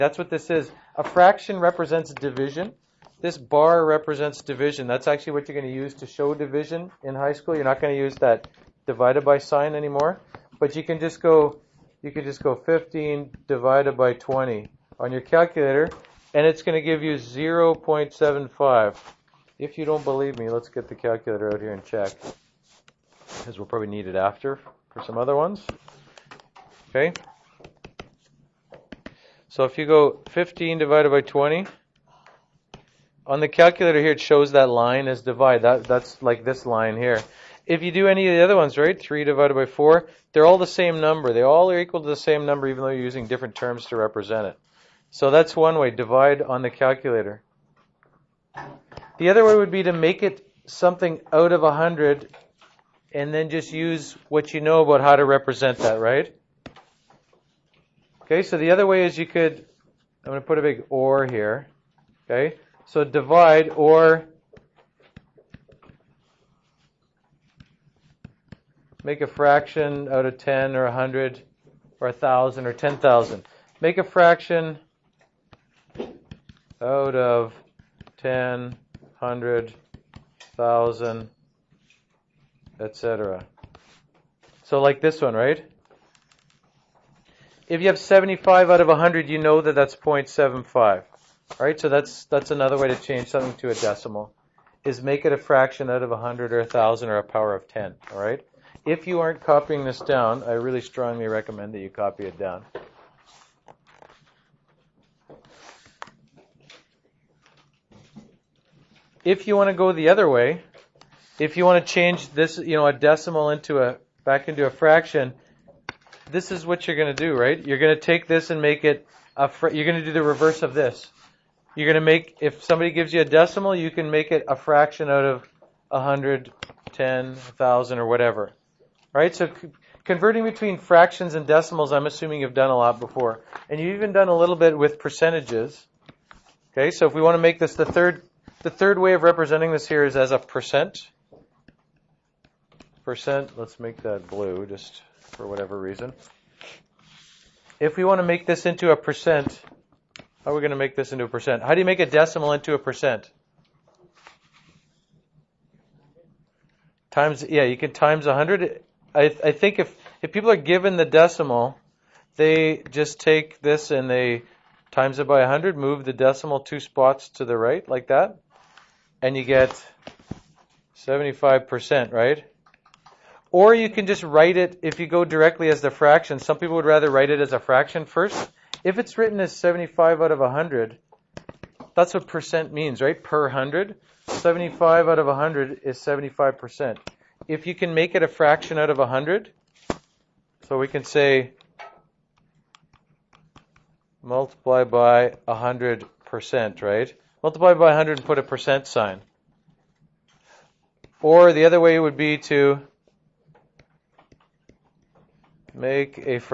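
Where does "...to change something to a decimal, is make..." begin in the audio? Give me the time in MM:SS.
01:32.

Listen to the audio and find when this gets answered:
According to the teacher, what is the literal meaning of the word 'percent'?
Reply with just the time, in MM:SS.
03:03.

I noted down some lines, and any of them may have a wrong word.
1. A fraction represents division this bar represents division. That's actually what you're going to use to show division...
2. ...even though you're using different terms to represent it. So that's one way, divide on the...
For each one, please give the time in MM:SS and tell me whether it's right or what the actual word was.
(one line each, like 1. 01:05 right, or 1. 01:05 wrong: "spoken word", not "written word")
1. 00:00 right
2. 00:42 right.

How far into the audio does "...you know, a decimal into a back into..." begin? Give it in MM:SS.
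01:52.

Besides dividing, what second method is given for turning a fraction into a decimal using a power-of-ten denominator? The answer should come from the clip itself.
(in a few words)
make a fraction out of 100.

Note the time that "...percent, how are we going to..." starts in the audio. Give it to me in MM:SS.
02:28.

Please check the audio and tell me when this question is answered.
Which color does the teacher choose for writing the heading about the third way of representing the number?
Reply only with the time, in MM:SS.
02:24.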